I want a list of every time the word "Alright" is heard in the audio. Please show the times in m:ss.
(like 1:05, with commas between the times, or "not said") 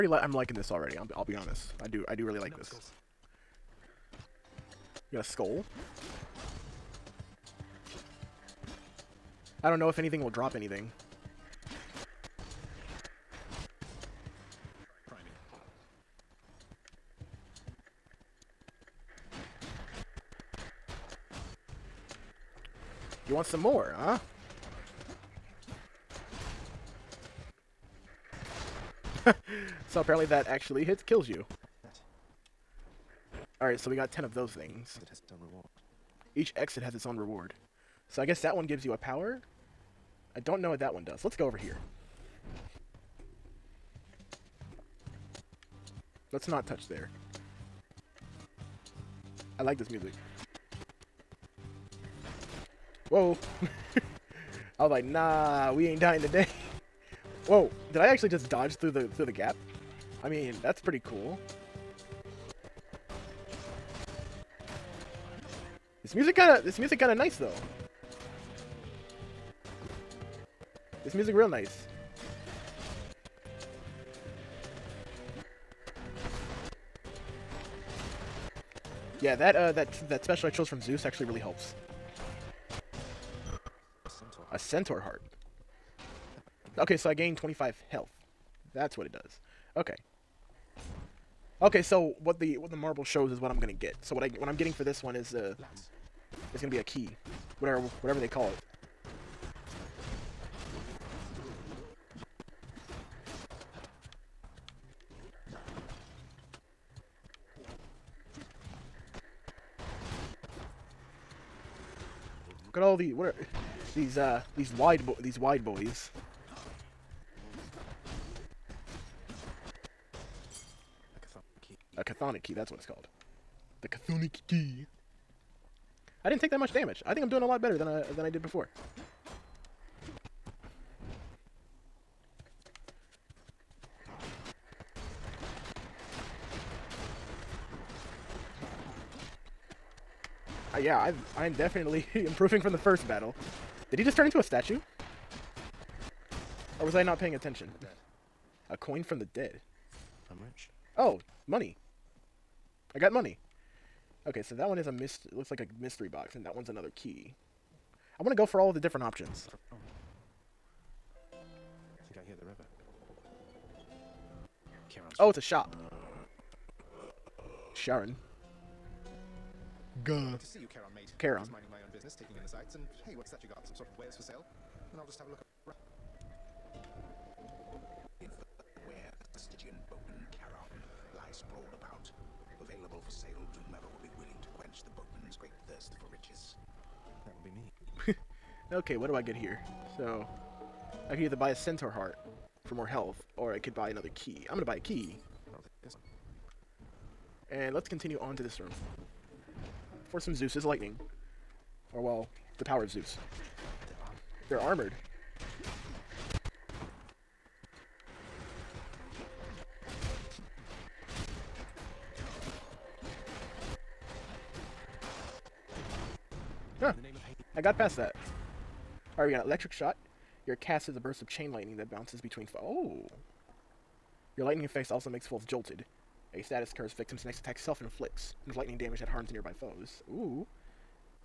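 0:33, 3:39.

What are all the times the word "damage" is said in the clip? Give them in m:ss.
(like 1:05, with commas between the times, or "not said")
2:06, 3:48.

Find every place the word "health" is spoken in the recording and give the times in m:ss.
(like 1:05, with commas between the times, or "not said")
1:27, 3:12.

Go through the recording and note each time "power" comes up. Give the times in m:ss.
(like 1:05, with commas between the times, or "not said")
0:38, 3:22.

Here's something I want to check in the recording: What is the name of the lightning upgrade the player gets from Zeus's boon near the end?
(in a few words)
Electric shot.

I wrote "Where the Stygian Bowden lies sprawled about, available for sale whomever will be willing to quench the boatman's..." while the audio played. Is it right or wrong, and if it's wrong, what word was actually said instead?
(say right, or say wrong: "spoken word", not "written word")
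right.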